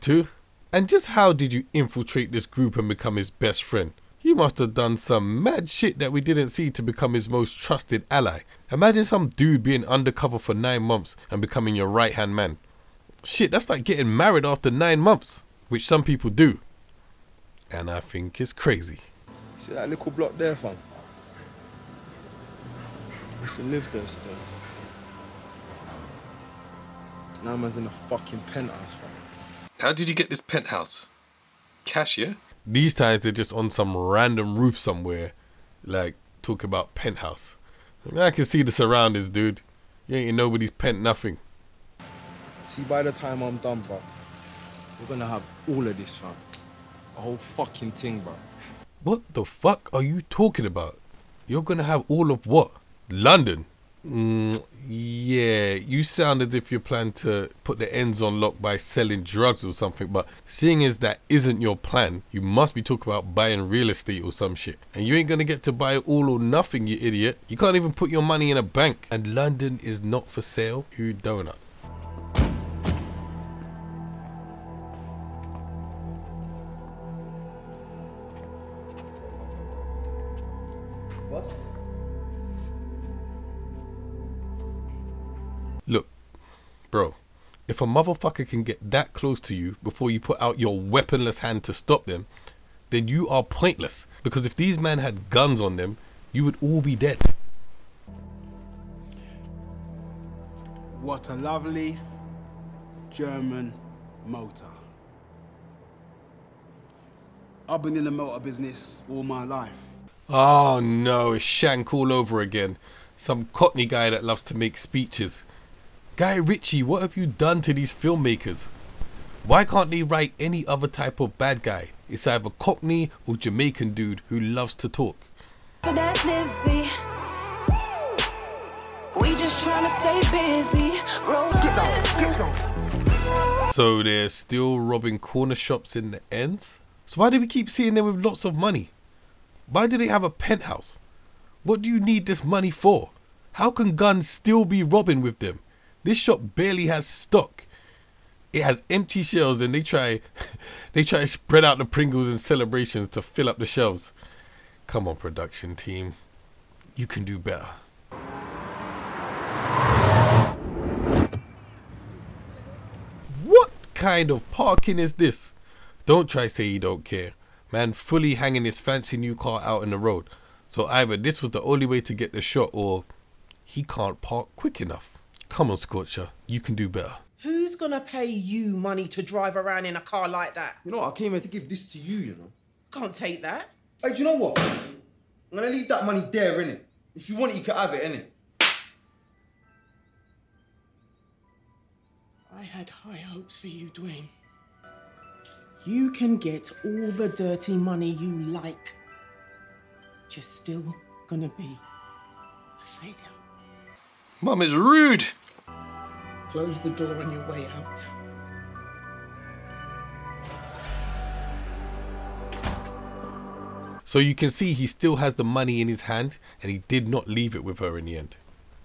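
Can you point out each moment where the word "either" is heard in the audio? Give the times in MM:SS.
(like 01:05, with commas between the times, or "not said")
02:02, 02:50.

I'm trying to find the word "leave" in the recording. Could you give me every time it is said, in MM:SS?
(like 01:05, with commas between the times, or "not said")
03:05, 03:37.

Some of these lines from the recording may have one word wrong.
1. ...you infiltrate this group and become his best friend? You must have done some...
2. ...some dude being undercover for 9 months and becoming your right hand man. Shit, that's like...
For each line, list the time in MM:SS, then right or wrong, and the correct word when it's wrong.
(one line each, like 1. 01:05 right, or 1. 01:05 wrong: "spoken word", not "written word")
1. 00:01 right
2. 00:09 right.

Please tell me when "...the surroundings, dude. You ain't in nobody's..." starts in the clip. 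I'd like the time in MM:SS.
00:38.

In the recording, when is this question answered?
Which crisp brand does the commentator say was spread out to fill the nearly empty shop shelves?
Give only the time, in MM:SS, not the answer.
02:31.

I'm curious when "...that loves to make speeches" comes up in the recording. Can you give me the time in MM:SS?
01:54.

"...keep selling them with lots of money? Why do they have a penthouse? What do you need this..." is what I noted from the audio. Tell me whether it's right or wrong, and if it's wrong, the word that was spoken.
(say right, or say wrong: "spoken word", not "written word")
wrong: "seeing", not "selling".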